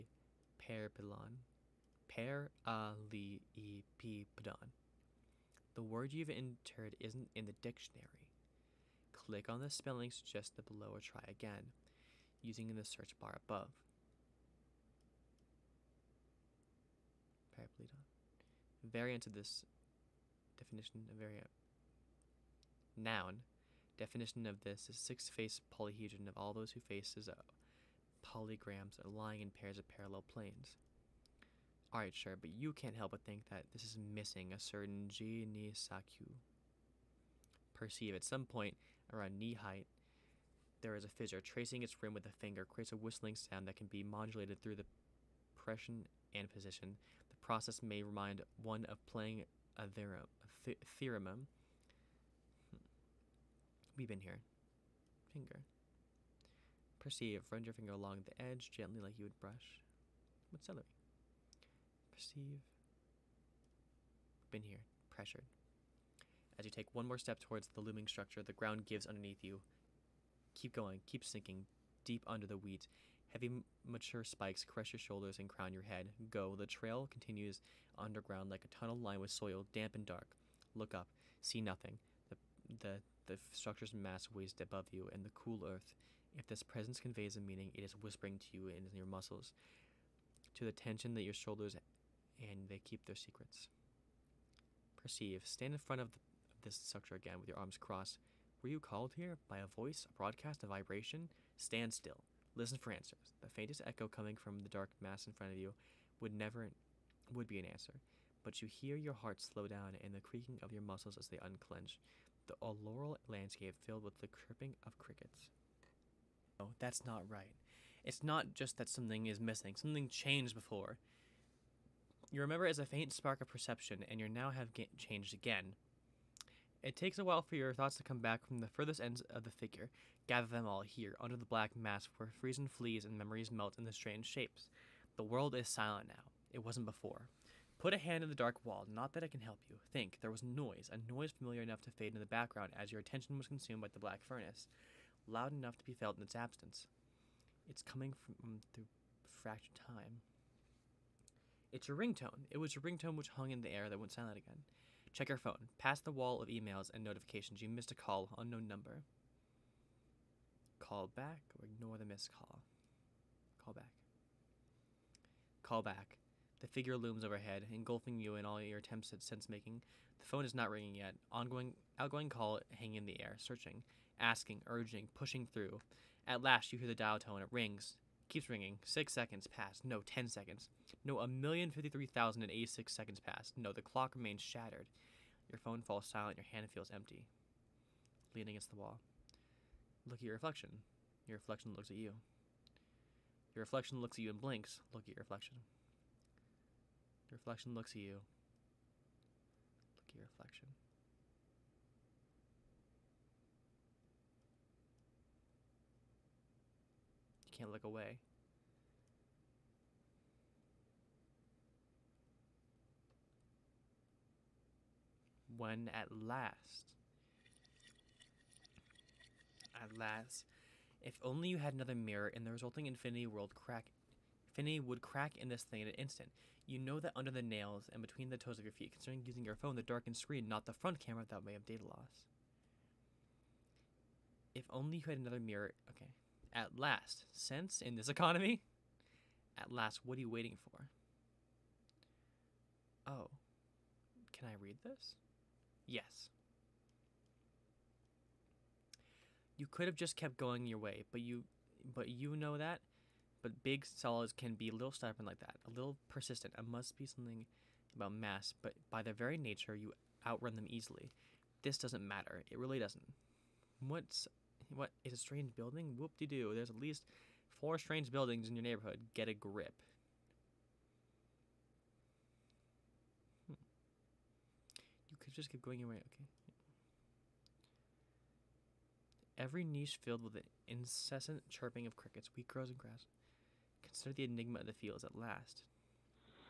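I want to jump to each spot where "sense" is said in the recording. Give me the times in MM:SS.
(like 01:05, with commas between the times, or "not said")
02:49, 03:57.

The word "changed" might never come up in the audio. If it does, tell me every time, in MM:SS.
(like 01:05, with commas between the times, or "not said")
02:00, 02:04.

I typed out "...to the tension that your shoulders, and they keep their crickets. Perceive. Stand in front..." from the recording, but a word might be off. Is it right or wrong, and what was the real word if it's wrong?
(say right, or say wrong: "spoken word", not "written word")
wrong: "secrets", not "crickets".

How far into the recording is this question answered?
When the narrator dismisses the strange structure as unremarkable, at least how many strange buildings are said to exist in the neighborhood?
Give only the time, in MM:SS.
04:27.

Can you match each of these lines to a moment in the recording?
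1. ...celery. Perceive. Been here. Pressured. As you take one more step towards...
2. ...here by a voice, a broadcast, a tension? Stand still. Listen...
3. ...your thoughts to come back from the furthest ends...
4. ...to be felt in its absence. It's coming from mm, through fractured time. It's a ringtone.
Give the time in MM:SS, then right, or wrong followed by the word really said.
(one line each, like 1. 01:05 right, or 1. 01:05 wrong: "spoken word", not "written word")
1. 01:00 right
2. 01:39 wrong: "vibration", not "tension"
3. 02:07 right
4. 02:25 right.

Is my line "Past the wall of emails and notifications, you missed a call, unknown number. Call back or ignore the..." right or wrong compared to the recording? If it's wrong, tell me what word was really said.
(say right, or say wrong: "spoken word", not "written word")
right.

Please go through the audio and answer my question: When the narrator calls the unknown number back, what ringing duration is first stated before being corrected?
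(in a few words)
6 seconds.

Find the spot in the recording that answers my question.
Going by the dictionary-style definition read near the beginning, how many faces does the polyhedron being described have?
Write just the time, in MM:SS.
00:24.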